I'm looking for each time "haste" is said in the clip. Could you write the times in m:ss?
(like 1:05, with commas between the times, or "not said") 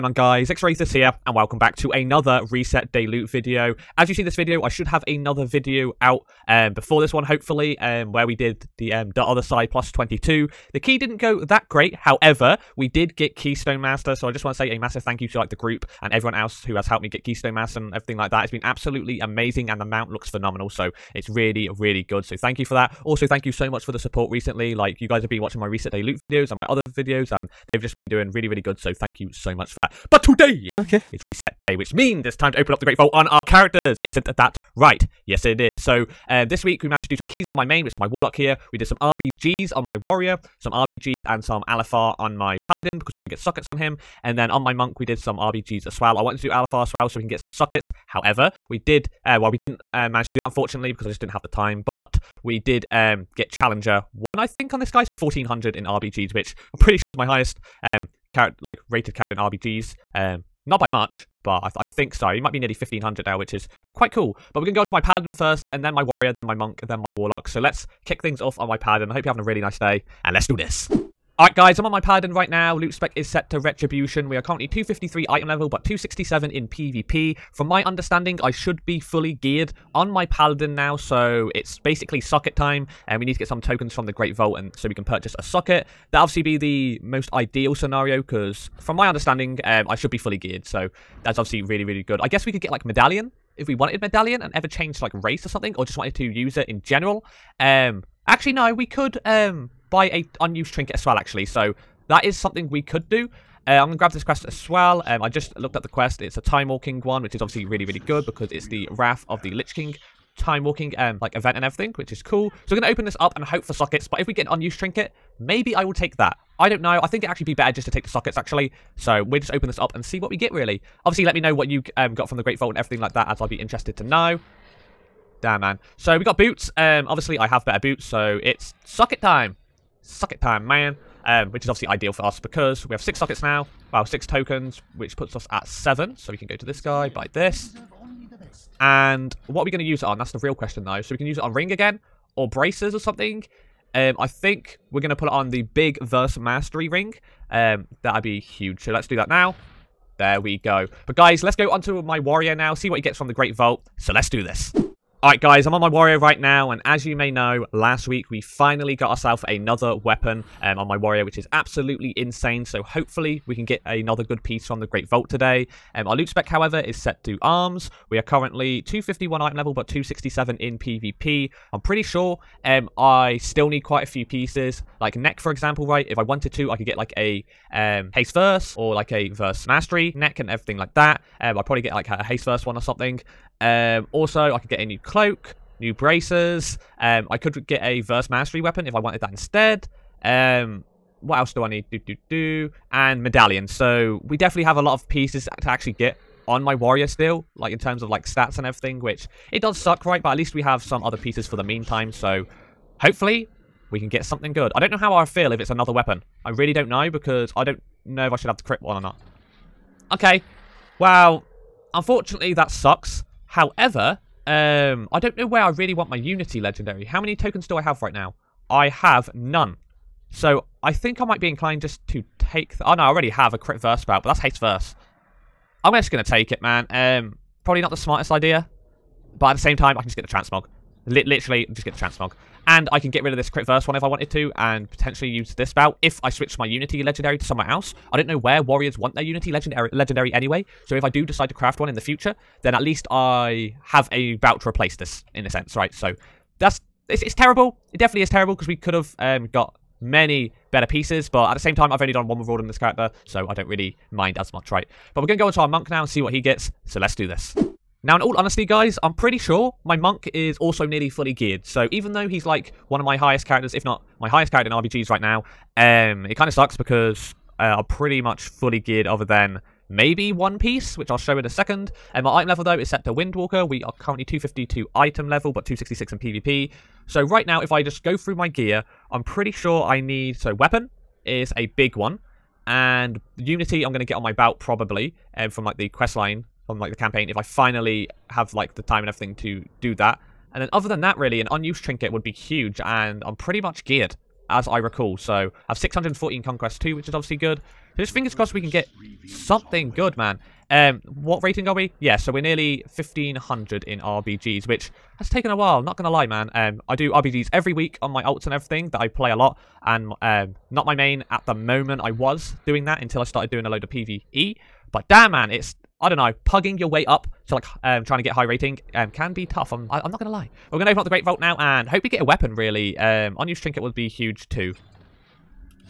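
2:58, 3:02, 3:44.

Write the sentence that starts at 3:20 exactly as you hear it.
But at least we have some other pieces for the meantime, so hopefully we can get something good.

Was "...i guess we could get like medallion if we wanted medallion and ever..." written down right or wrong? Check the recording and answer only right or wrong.
right.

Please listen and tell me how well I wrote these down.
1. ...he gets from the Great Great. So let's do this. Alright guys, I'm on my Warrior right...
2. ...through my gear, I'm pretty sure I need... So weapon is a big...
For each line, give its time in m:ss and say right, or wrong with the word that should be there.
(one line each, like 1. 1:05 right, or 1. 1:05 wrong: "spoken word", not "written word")
1. 2:32 wrong: "Vault", not "Great"
2. 4:38 right.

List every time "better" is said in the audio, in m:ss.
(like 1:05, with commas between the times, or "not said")
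1:57, 2:07, 4:10.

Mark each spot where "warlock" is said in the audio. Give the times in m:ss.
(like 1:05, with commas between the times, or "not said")
0:38, 1:07.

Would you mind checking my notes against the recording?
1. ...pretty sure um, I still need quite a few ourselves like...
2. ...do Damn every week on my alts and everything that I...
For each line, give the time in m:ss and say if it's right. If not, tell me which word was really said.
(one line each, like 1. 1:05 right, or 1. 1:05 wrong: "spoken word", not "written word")
1. 2:51 wrong: "pieces", not "ourselves"
2. 5:06 wrong: "RBGs", not "Damn".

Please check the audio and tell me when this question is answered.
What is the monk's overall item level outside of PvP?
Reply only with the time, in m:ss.
4:34.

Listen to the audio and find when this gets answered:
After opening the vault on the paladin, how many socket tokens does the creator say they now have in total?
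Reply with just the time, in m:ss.
2:15.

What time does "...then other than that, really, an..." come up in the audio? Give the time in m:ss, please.
4:50.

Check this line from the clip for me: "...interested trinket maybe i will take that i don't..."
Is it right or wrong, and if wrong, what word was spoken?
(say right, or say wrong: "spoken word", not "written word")
wrong: "unused", not "interested".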